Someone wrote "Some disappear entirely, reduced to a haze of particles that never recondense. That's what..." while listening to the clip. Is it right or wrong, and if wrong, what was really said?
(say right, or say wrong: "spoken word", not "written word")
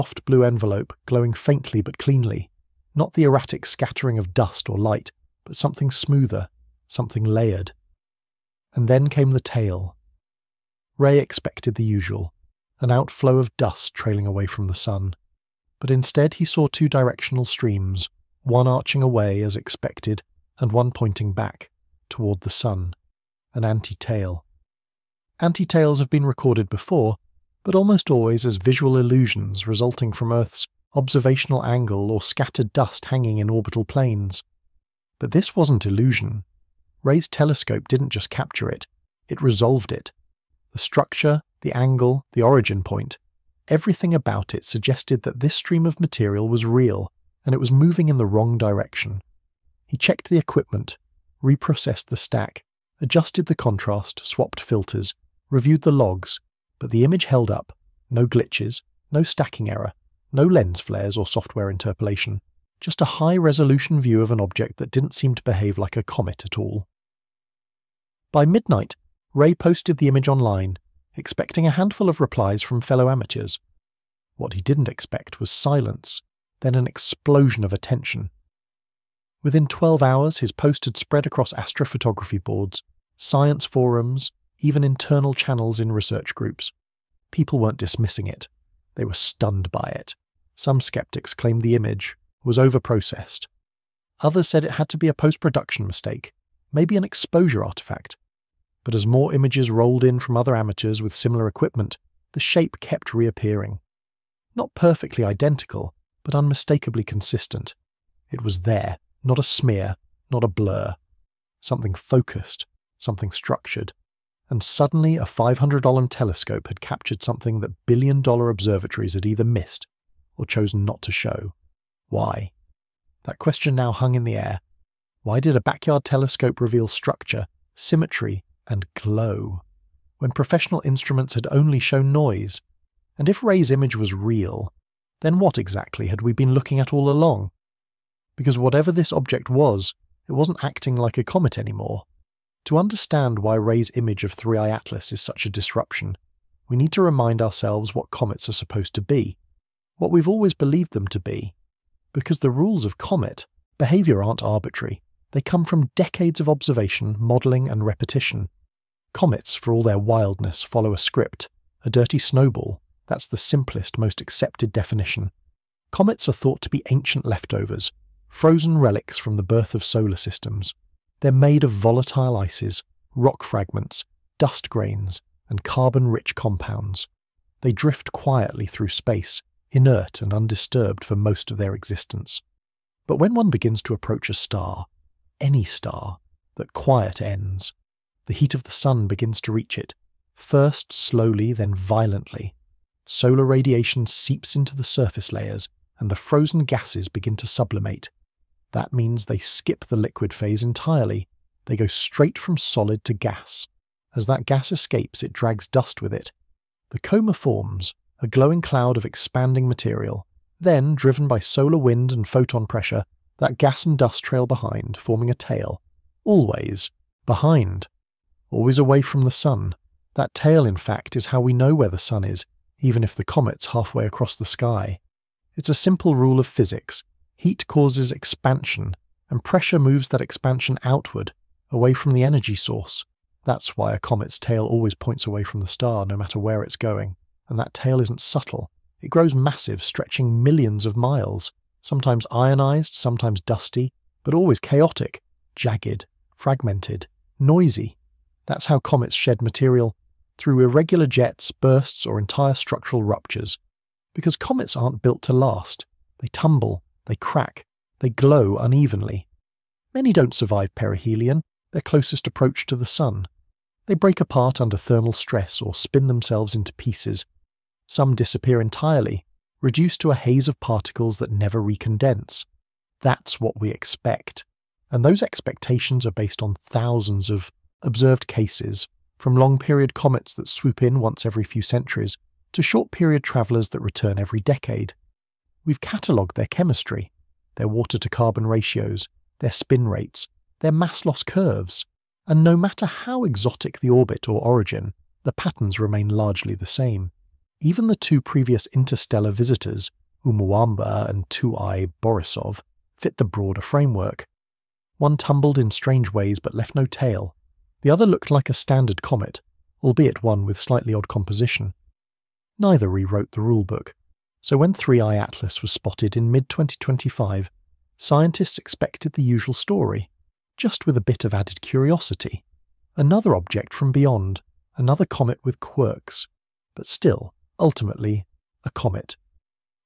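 right.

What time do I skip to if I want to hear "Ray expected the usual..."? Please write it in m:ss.
0:10.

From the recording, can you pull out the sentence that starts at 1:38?
But as more images rolled in from other amateurs with similar equipment, the shape kept reappearing.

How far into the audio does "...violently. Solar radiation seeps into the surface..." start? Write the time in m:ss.
3:11.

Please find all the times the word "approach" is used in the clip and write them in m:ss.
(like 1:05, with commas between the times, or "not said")
3:03, 4:22.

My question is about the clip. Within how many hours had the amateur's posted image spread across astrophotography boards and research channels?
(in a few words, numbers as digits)
12.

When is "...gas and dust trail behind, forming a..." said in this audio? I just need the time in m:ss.
3:33.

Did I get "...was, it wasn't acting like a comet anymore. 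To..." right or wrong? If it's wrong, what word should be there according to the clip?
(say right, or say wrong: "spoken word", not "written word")
right.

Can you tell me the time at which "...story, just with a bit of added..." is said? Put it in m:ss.
5:19.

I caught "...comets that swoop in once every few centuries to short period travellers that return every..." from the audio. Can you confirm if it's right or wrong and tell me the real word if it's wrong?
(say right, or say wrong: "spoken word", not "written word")
right.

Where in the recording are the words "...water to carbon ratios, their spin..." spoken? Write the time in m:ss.
4:47.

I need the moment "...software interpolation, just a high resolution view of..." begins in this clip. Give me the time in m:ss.
1:01.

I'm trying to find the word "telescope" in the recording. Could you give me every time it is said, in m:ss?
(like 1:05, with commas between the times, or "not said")
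0:37, 1:56, 2:06.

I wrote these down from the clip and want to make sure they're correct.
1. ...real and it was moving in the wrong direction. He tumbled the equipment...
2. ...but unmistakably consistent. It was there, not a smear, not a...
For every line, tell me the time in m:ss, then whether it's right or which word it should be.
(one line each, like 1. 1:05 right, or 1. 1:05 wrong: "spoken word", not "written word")
1. 0:46 wrong: "checked", not "tumbled"
2. 1:46 right.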